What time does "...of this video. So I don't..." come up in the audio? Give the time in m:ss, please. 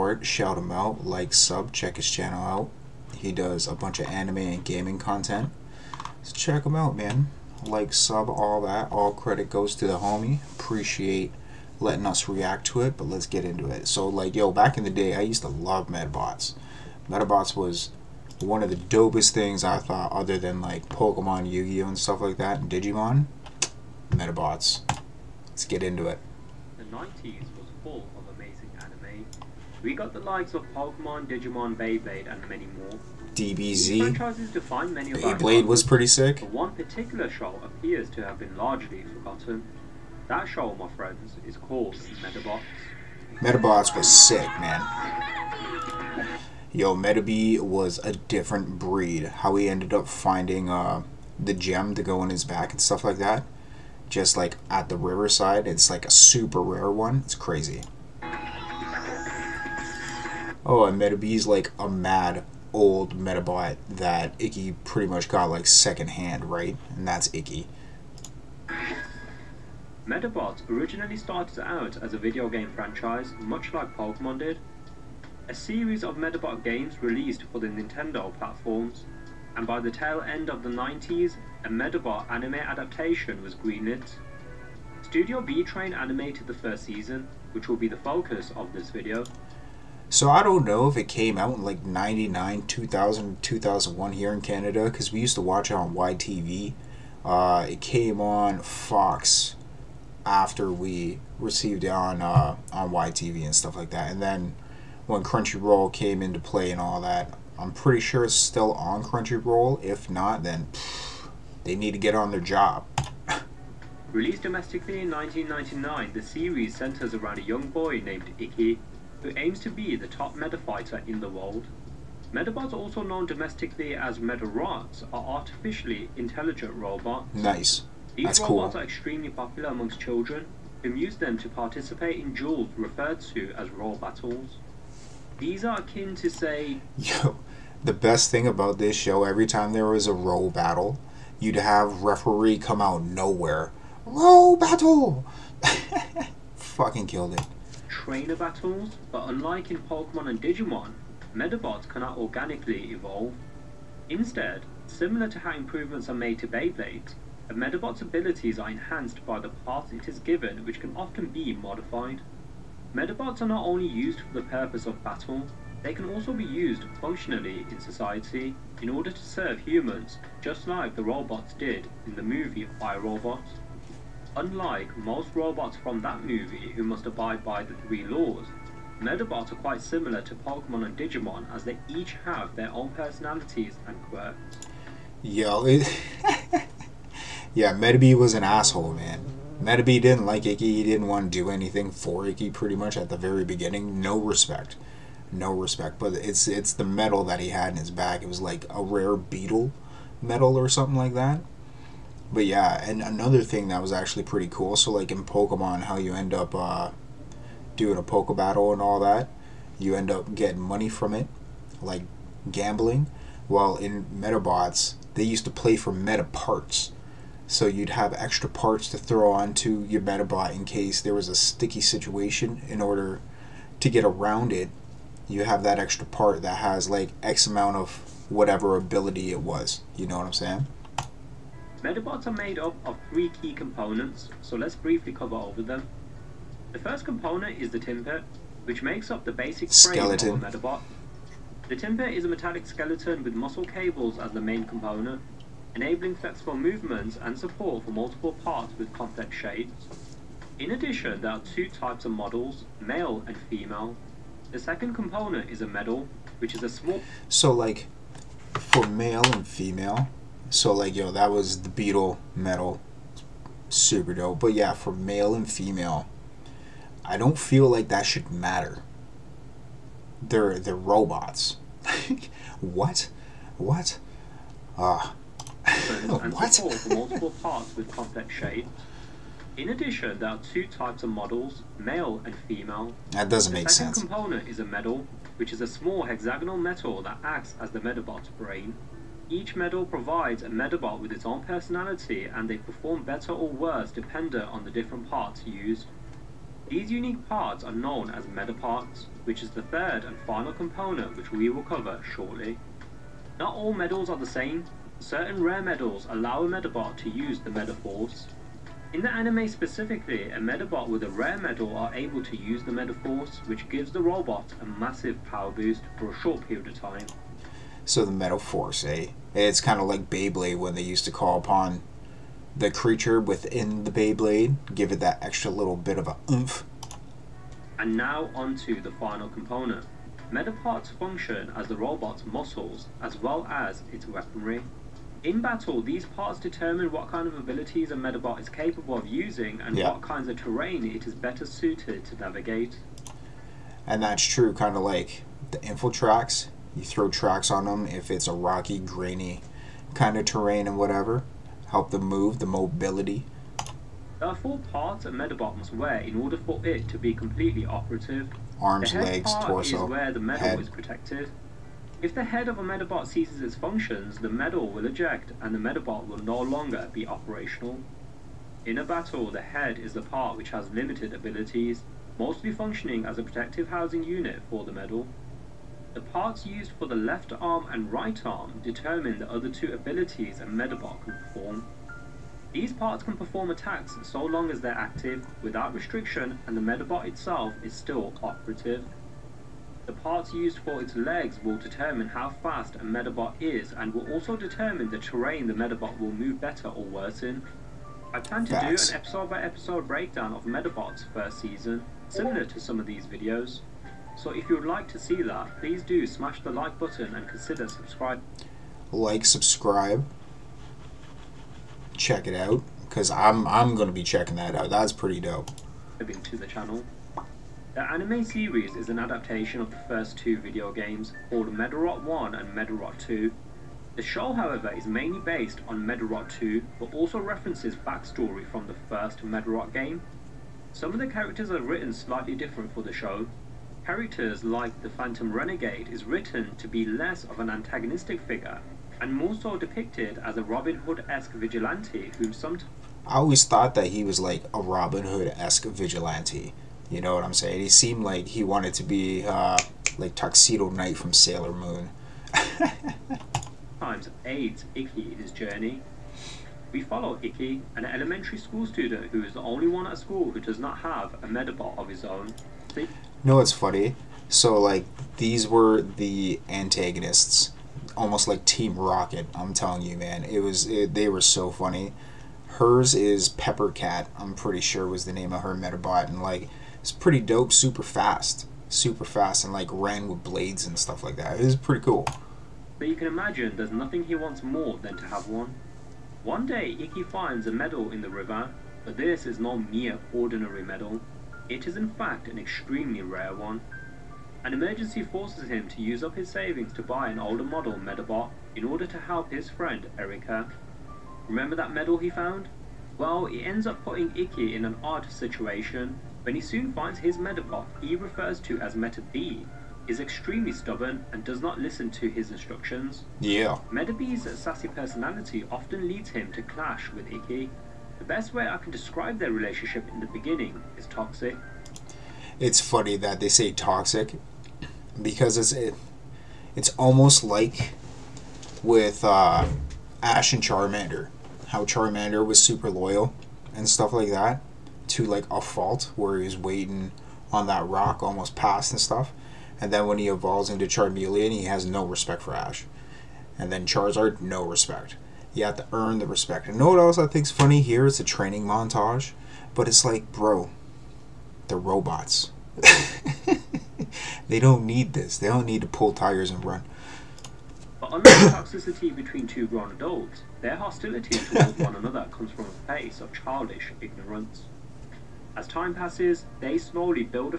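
1:28.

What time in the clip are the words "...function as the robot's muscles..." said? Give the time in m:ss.
5:30.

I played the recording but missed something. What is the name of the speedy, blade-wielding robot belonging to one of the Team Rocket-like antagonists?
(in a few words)
Peppercat.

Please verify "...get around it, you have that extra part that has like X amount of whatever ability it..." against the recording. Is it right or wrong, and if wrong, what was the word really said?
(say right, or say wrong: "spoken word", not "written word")
right.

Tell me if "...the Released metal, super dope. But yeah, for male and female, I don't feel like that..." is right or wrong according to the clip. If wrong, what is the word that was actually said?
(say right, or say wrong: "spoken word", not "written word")
wrong: "Beatle", not "Released".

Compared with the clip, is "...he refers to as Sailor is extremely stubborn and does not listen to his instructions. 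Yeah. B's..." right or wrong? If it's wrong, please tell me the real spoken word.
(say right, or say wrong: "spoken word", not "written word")
wrong: "Metabee", not "Sailor".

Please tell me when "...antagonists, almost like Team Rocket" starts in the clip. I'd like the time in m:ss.
7:46.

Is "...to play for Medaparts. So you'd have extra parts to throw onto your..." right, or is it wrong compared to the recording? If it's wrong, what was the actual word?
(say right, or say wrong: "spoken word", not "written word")
right.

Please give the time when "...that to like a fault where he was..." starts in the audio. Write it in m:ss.
8:54.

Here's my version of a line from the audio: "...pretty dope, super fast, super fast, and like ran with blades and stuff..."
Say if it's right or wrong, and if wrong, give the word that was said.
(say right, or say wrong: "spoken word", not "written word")
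right.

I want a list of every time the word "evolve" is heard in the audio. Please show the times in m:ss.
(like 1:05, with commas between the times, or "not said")
2:32, 9:00.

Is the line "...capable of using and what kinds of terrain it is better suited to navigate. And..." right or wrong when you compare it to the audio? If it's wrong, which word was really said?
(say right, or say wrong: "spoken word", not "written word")
right.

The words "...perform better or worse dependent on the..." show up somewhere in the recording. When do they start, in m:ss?
4:52.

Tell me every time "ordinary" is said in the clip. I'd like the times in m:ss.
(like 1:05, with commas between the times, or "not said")
8:10.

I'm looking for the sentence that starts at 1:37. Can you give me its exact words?
Uh, it came on Fox after we received it on, uh, on YTV and stuff like that.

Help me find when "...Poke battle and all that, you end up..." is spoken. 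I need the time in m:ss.
3:28.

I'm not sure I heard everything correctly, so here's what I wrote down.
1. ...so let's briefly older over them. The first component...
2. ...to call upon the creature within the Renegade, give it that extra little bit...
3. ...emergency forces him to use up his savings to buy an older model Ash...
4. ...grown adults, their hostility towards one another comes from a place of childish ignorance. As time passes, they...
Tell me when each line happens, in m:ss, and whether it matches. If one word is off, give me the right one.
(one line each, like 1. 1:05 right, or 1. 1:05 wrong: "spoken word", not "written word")
1. 3:54 wrong: "cover", not "older"
2. 5:21 wrong: "Beyblade", not "Renegade"
3. 8:14 wrong: "Medabot", not "Ash"
4. 9:19 right.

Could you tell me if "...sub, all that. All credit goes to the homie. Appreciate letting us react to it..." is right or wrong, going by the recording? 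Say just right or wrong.
right.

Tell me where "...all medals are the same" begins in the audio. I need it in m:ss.
5:03.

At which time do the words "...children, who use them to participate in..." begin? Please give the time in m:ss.
2:09.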